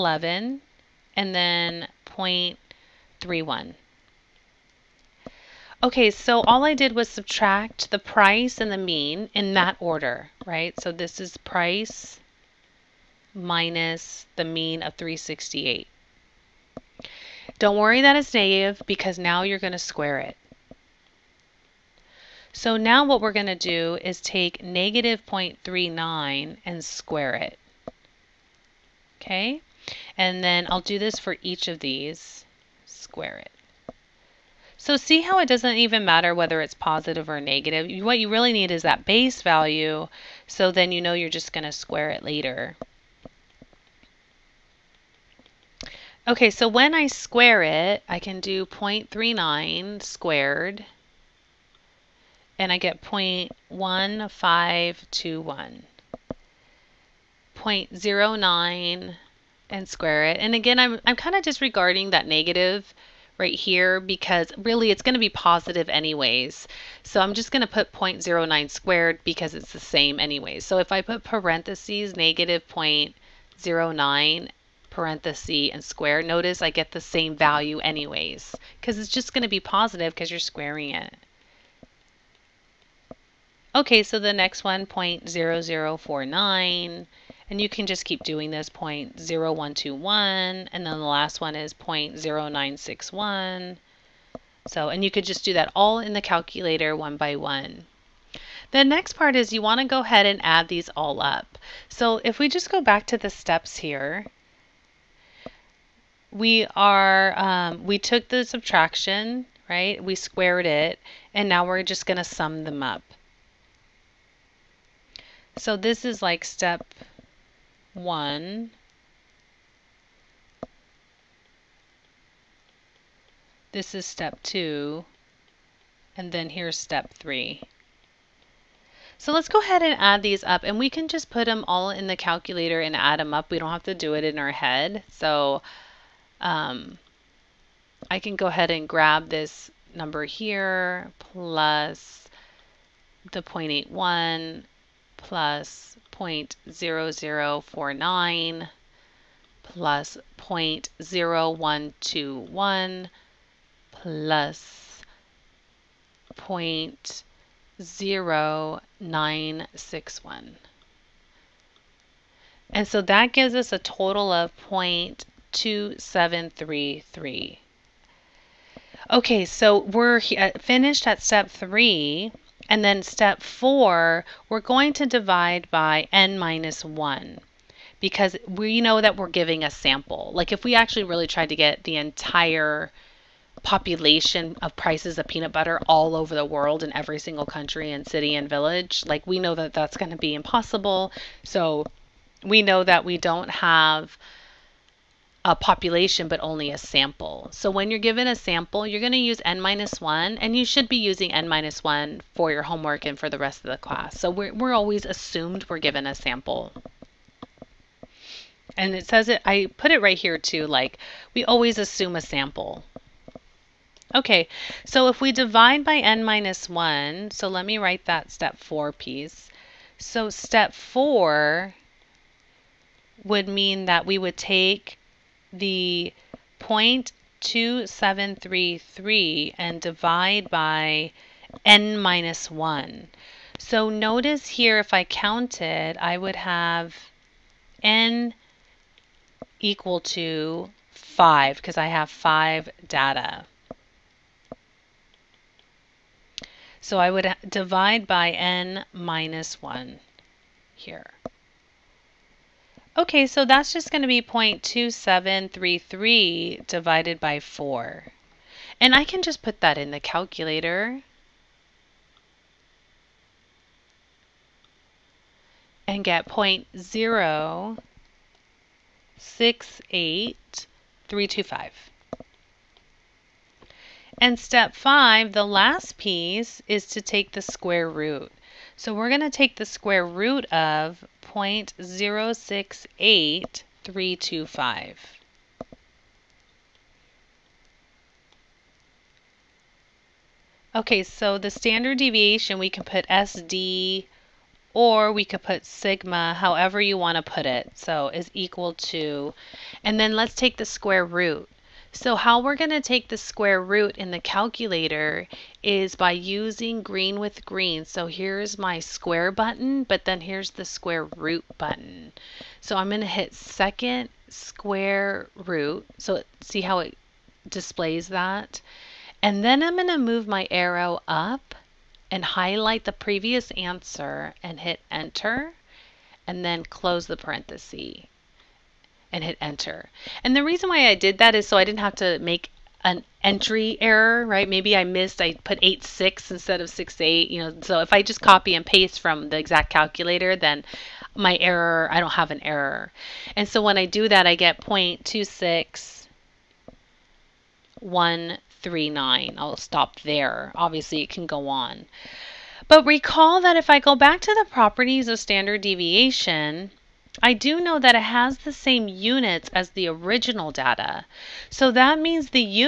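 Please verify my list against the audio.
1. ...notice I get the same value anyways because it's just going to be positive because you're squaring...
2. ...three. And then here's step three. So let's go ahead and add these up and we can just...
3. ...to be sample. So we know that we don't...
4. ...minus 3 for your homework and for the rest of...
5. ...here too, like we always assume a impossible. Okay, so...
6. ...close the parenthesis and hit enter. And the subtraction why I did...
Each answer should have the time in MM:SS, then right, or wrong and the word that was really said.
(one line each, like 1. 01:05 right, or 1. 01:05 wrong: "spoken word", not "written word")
1. 01:16 right
2. 02:04 wrong: "two", not "three"
3. 03:10 wrong: "impossible", not "sample"
4. 03:21 wrong: "1", not "3"
5. 03:30 wrong: "sample", not "impossible"
6. 05:26 wrong: "reason", not "subtraction".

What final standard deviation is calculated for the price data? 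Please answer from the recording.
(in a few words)
0.26139.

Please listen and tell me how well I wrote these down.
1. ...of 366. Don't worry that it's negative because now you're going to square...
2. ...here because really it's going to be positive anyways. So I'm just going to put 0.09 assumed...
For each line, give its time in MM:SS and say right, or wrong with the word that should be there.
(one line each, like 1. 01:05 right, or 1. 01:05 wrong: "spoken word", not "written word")
1. 00:14 wrong: "368", not "366"
2. 01:03 wrong: "squared", not "assumed".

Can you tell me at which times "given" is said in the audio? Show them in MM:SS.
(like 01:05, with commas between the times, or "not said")
03:17, 03:25.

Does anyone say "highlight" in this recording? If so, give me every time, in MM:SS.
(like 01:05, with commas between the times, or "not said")
05:22.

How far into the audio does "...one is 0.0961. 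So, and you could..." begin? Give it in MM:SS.
01:31.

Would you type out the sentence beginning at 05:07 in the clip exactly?
So here's my square button, but then here's the square root button.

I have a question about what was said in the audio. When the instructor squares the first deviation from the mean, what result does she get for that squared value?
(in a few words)
0.1521.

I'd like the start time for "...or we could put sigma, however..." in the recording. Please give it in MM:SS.
04:54.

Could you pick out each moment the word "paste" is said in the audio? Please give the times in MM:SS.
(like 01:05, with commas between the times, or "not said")
05:38.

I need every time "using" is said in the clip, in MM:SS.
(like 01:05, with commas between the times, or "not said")
03:20, 05:06.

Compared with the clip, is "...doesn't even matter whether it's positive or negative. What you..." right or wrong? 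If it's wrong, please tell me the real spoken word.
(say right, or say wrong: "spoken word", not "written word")
right.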